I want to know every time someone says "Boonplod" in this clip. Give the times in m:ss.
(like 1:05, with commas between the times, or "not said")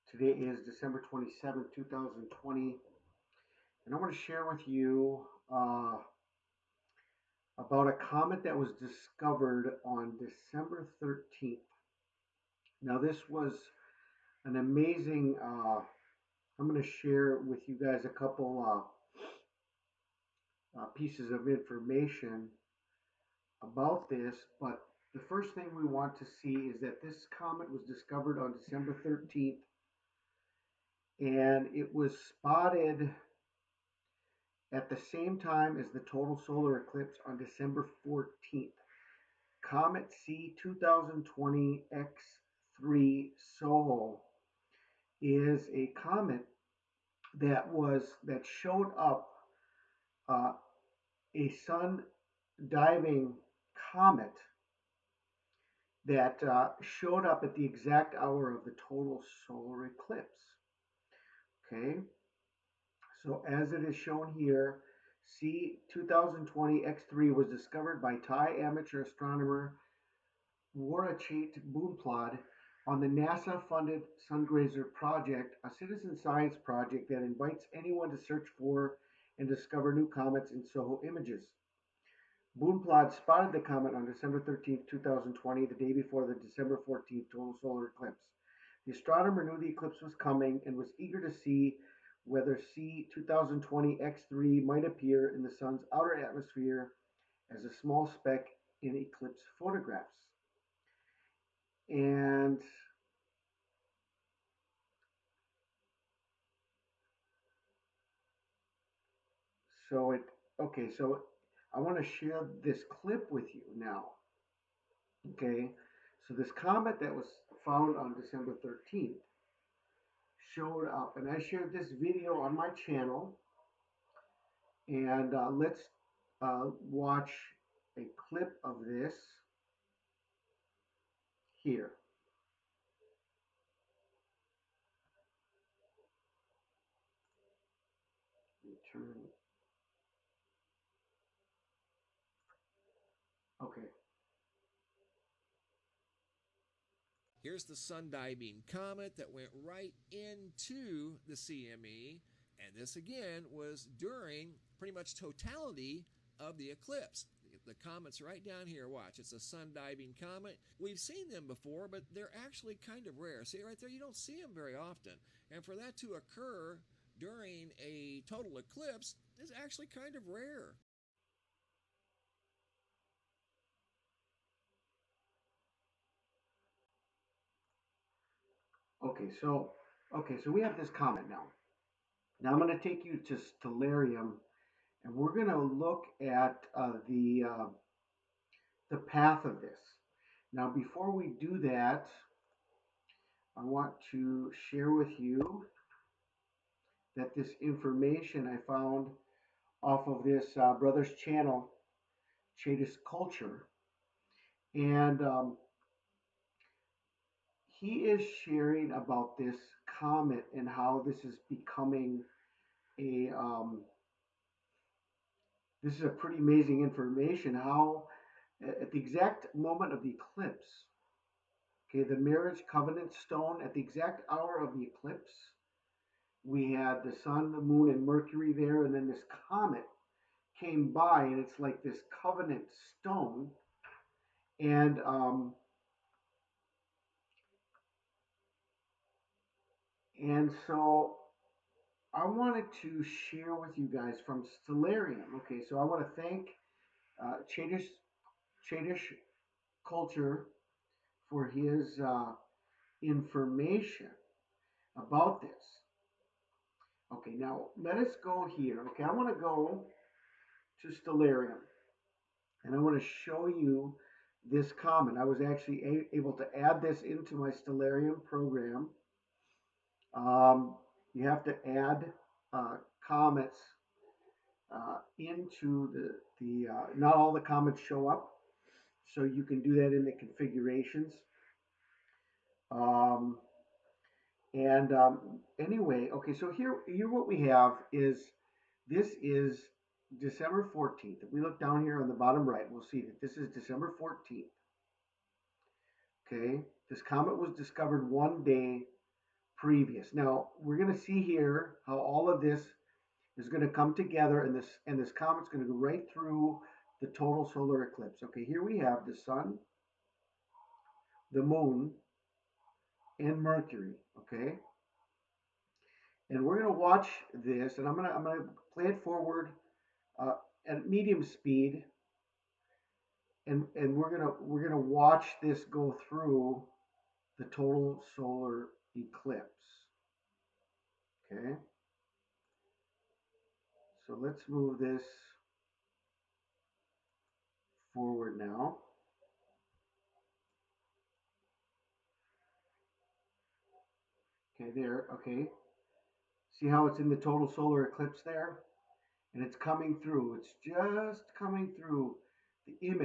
1:11, 1:22.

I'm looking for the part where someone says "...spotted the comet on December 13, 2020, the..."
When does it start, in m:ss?
1:23.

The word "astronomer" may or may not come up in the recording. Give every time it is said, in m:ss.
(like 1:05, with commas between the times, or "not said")
1:09, 1:28.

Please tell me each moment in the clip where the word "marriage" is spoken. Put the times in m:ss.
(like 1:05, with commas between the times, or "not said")
3:42.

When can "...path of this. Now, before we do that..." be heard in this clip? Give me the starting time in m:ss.
3:08.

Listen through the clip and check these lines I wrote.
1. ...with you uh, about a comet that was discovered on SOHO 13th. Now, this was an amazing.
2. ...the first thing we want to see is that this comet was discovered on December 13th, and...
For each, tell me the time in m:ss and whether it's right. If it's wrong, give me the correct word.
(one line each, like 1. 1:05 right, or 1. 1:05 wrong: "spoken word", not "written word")
1. 0:04 wrong: "December", not "SOHO"
2. 0:25 right.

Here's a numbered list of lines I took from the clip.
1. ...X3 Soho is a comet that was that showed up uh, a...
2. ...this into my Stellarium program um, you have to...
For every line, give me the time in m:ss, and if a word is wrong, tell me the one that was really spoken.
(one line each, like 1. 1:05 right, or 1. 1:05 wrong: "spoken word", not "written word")
1. 0:42 right
2. 4:26 right.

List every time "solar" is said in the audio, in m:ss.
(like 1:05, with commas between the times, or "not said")
0:36, 0:59, 1:27, 5:07, 5:28, 5:47.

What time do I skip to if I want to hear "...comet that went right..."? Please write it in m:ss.
2:28.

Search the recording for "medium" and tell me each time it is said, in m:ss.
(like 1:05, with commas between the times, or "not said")
5:20.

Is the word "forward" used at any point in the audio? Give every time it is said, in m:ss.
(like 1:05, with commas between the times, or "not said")
5:19, 5:37.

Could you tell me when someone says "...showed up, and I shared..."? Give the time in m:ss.
2:00.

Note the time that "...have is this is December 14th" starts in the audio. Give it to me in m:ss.
4:47.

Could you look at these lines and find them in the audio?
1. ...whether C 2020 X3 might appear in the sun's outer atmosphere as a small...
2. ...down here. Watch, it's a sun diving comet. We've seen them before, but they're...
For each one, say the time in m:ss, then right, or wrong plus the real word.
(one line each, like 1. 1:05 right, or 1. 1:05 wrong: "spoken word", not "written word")
1. 1:32 right
2. 2:38 right.